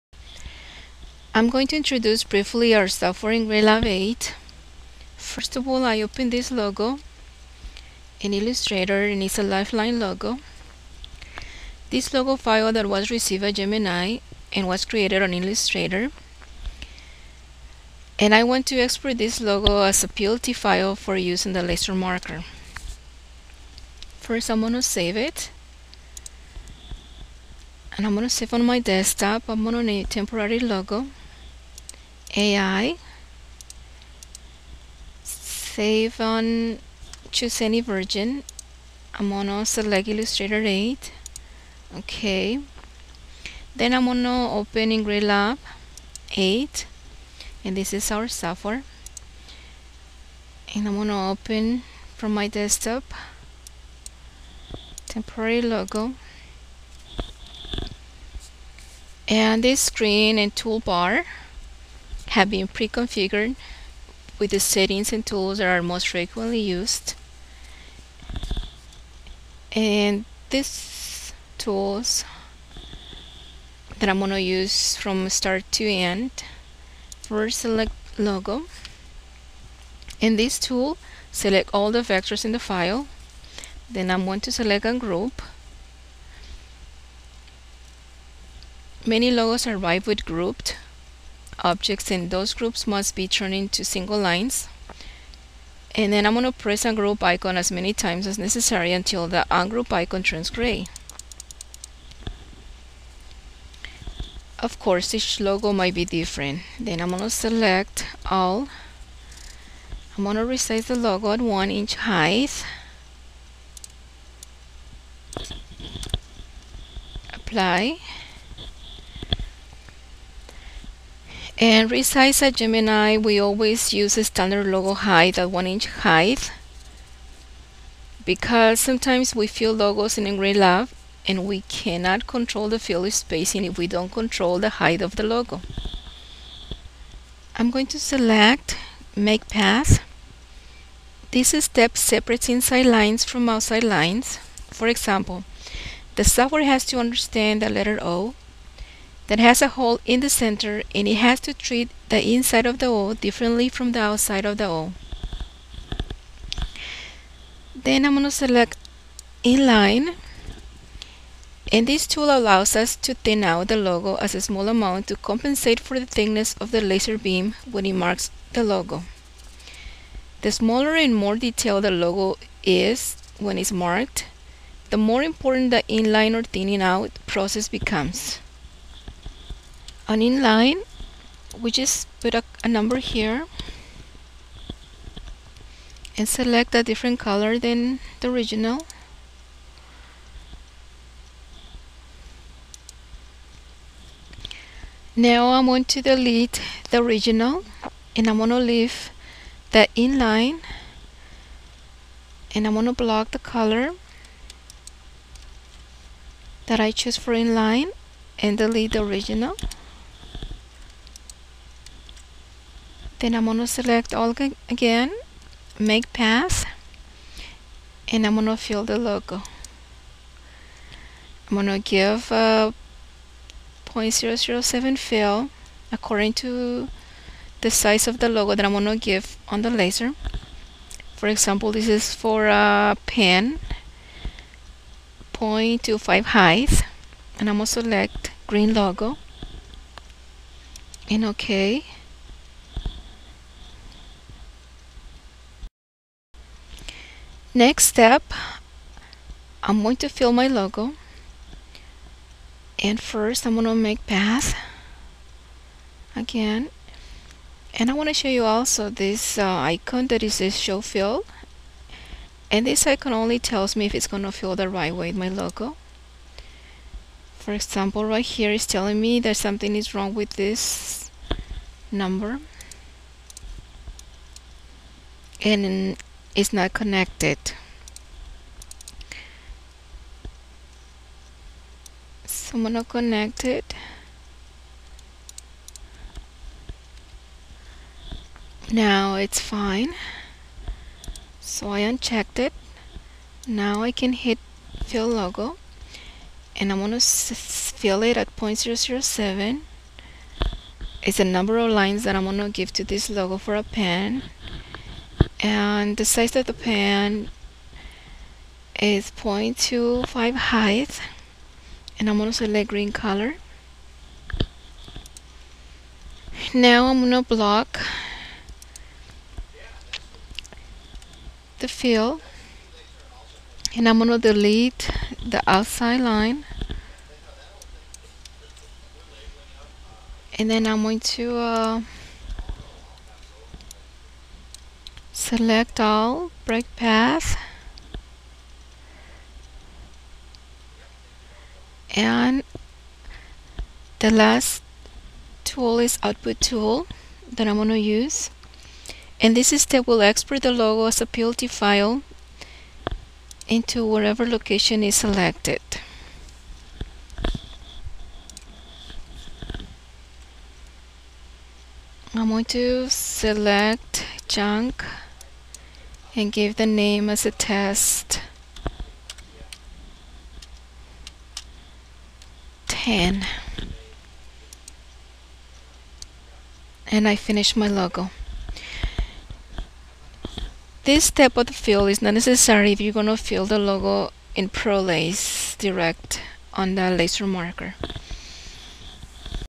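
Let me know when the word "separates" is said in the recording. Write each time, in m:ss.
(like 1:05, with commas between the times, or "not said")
2:21.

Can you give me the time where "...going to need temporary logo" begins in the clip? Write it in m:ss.
0:29.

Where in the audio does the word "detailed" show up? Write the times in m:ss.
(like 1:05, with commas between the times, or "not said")
2:51.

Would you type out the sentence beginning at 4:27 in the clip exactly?
For example, right here is telling me that something is wrong with this number.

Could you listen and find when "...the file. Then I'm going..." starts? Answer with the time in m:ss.
1:22.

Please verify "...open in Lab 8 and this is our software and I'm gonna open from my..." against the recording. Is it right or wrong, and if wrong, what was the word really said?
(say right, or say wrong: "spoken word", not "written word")
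right.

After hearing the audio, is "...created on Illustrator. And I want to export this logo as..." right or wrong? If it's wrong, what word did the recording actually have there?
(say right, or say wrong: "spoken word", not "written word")
right.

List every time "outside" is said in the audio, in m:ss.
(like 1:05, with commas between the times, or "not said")
2:23, 2:33, 5:25.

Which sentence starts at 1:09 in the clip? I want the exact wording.
And these tools that I'm going to use from start to end.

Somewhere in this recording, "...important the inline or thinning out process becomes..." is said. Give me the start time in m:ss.
2:55.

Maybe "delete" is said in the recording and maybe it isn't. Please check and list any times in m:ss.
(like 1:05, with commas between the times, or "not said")
3:16, 3:28, 5:24.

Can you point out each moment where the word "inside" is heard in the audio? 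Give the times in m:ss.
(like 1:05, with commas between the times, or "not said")
2:22, 2:32.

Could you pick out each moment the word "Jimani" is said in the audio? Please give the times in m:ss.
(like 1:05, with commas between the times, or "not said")
0:13, 2:02.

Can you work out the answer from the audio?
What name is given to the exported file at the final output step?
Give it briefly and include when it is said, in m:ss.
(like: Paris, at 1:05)
test 10, at 6:07.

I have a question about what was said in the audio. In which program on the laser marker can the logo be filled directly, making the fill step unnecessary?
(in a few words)
ProLace.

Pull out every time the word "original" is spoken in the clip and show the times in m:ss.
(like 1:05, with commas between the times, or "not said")
3:08, 3:16, 3:29.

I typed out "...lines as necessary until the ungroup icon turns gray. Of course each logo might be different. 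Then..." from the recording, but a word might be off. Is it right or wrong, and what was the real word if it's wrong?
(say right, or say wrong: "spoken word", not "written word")
wrong: "times", not "lines".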